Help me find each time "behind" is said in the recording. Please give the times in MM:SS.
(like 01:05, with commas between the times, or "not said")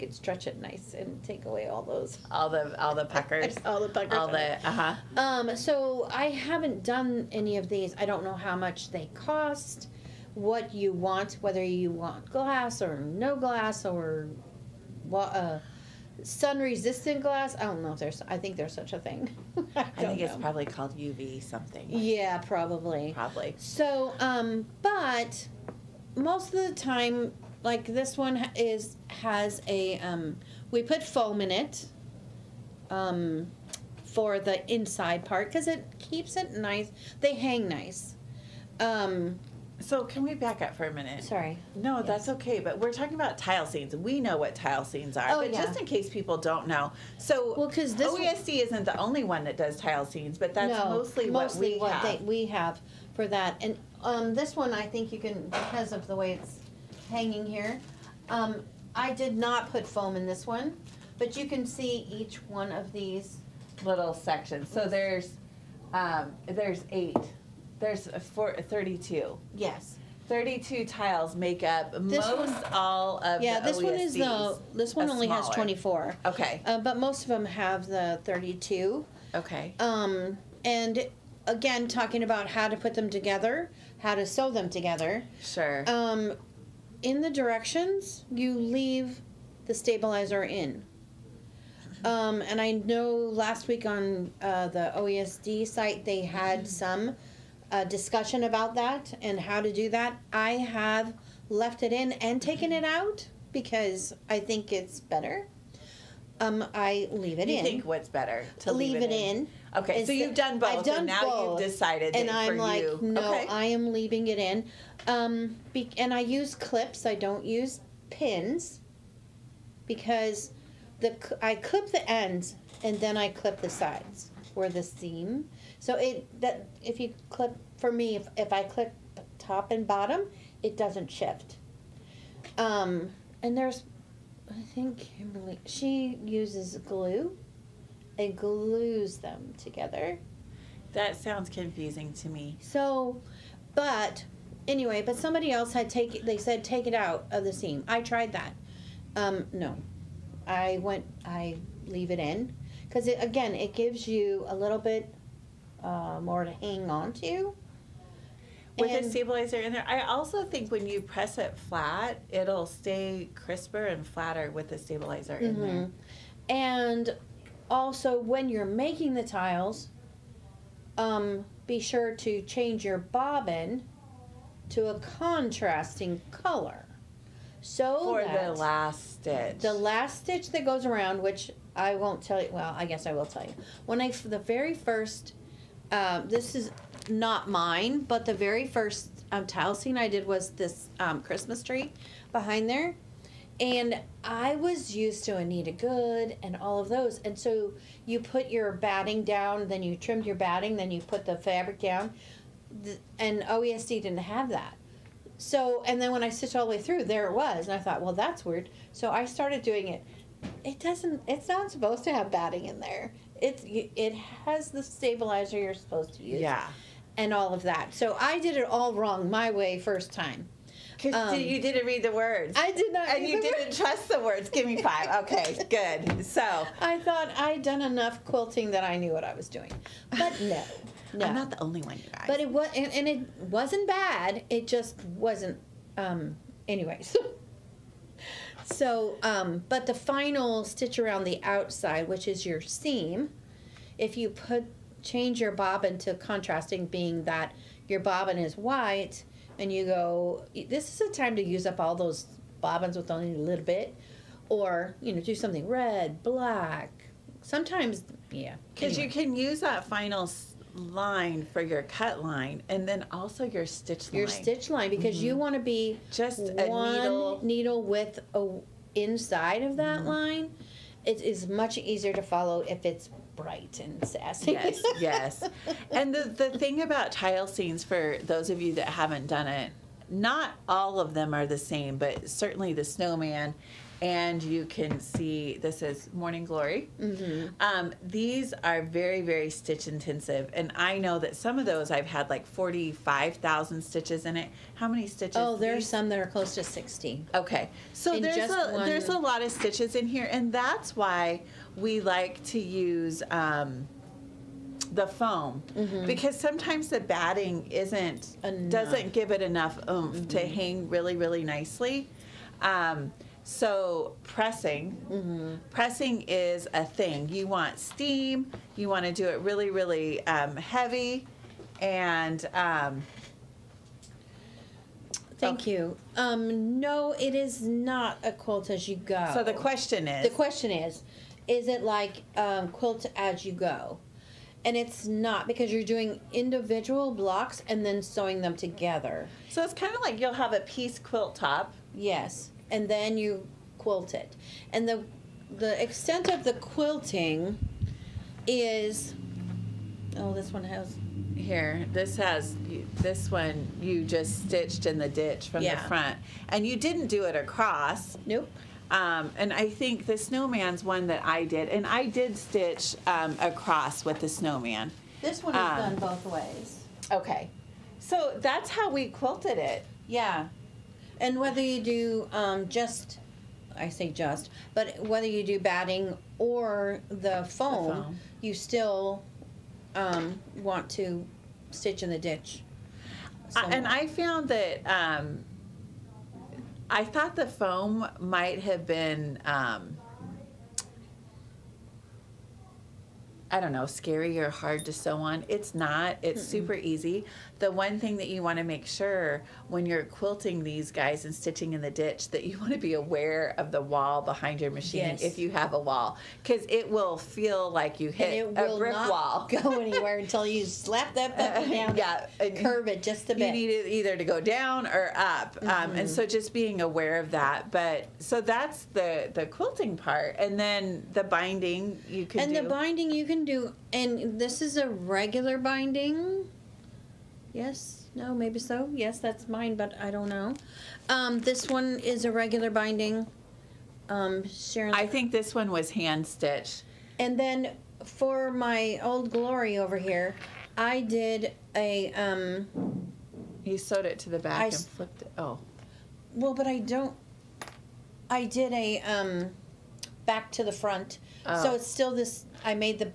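03:12, 06:44.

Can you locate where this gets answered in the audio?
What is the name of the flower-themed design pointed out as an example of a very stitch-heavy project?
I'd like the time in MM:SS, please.
04:46.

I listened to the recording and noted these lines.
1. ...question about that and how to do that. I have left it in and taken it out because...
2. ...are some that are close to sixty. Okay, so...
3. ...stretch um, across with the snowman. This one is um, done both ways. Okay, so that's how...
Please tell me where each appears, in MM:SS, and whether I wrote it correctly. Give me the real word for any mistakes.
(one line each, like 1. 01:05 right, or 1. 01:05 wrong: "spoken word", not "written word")
1. 01:37 wrong: "discussion", not "question"
2. 04:55 right
3. 06:02 wrong: "stitch", not "stretch".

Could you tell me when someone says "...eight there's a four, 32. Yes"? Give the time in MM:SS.
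01:06.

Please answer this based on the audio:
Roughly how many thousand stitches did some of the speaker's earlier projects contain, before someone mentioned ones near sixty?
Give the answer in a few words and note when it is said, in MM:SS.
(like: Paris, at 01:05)
45,000, at 04:52.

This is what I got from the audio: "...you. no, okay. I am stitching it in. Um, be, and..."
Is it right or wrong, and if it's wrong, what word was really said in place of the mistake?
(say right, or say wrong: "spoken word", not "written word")
wrong: "leaving", not "stitching".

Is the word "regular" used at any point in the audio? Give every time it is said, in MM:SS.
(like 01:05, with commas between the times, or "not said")
07:04, 07:12.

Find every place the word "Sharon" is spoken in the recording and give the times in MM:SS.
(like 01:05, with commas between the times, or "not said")
07:14.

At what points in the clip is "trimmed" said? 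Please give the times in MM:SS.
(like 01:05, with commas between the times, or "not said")
03:19.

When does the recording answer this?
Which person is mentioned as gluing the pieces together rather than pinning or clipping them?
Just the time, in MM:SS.
02:14.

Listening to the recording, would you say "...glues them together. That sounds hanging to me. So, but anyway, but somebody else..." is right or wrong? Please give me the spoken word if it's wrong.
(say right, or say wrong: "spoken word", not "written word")
wrong: "confusing", not "hanging".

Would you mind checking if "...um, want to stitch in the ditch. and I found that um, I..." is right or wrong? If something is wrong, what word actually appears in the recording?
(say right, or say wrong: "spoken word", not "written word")
right.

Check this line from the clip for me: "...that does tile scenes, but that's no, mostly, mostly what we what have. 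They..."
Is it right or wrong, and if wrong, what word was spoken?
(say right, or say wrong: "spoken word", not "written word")
right.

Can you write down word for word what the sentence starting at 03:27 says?
And I thought, well, that's weird.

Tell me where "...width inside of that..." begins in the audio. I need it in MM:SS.
04:27.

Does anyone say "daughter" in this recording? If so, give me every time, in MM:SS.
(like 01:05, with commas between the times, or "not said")
not said.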